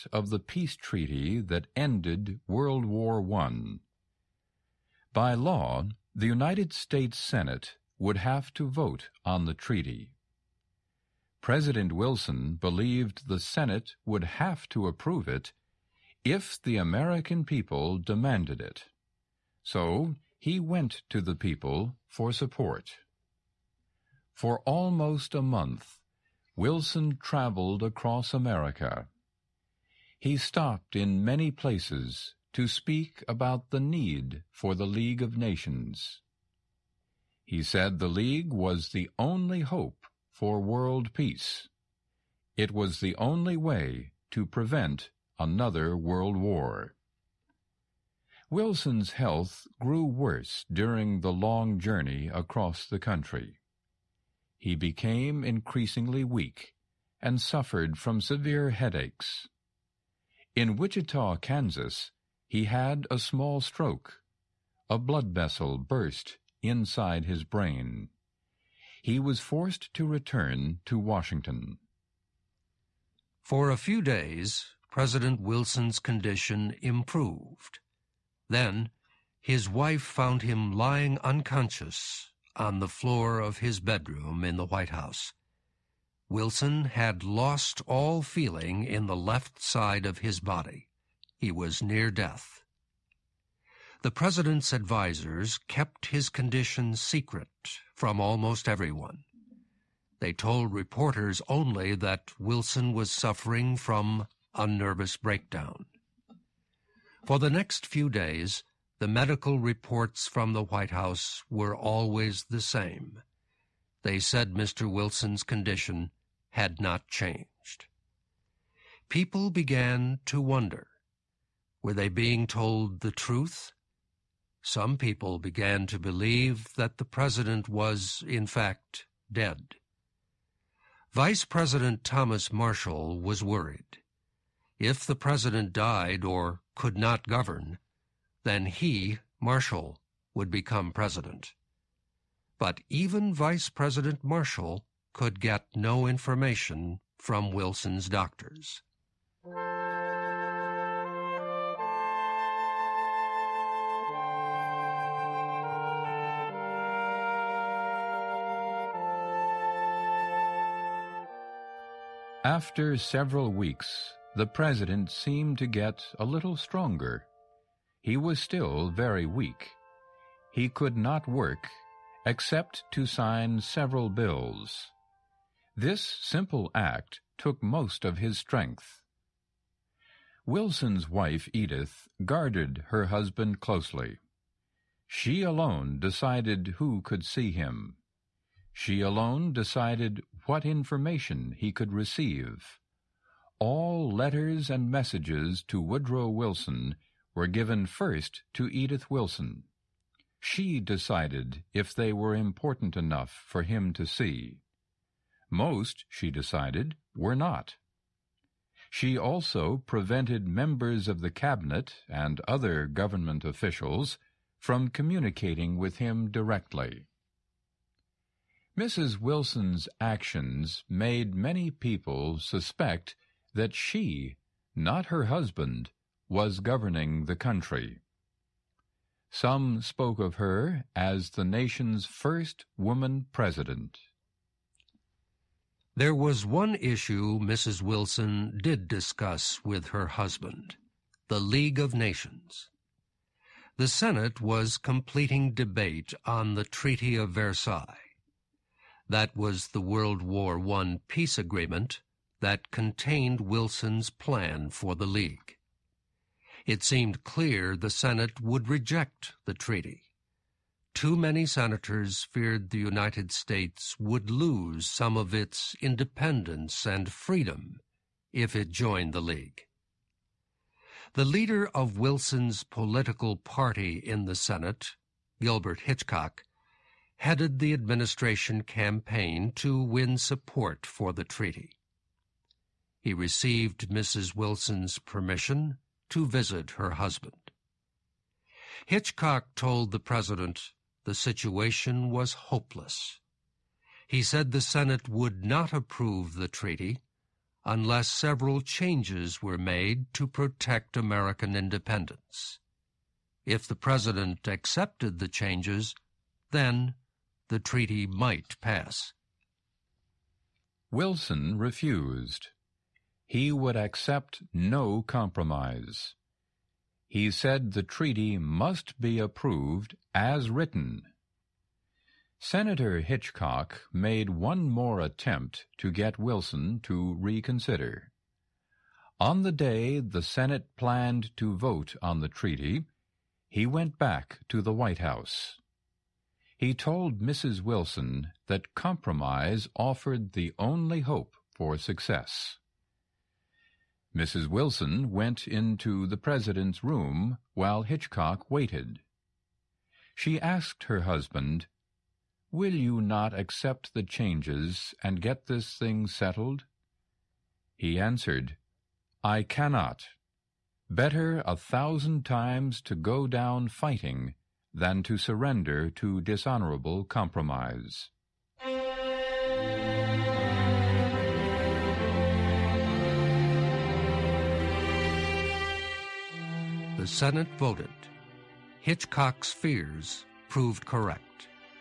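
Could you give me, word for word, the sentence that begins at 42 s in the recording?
It was the only way to prevent another world war.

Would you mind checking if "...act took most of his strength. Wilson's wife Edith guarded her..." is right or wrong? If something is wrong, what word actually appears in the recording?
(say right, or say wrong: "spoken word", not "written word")
right.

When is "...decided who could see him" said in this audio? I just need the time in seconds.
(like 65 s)
185 s.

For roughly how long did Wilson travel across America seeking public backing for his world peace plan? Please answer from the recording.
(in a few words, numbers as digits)
almost a month.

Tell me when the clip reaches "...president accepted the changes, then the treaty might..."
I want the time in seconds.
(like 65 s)
303 s.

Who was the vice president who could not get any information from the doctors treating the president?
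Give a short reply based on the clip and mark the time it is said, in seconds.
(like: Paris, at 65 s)
Thomas Marshall, at 132 s.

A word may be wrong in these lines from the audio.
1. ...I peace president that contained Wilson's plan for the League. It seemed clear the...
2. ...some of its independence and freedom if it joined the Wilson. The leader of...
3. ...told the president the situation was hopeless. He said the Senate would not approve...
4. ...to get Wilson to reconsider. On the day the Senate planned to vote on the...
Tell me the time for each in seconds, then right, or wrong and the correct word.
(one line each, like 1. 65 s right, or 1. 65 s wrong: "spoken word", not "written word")
1. 250 s wrong: "agreement", not "president"
2. 264 s wrong: "League", not "Wilson"
3. 289 s right
4. 325 s right.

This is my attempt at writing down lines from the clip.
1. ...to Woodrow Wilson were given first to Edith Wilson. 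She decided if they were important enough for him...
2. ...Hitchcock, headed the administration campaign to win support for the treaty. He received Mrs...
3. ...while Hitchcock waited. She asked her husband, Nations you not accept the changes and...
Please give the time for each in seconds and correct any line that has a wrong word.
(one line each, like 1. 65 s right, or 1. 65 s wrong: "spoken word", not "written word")
1. 195 s right
2. 275 s right
3. 347 s wrong: "Will", not "Nations".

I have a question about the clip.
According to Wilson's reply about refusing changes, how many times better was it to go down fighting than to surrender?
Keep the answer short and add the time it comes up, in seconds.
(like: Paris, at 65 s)
1000 times, at 361 s.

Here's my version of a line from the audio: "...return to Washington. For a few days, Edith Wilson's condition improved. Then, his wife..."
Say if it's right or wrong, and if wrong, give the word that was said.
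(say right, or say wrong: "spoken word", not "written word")
wrong: "President", not "Edith".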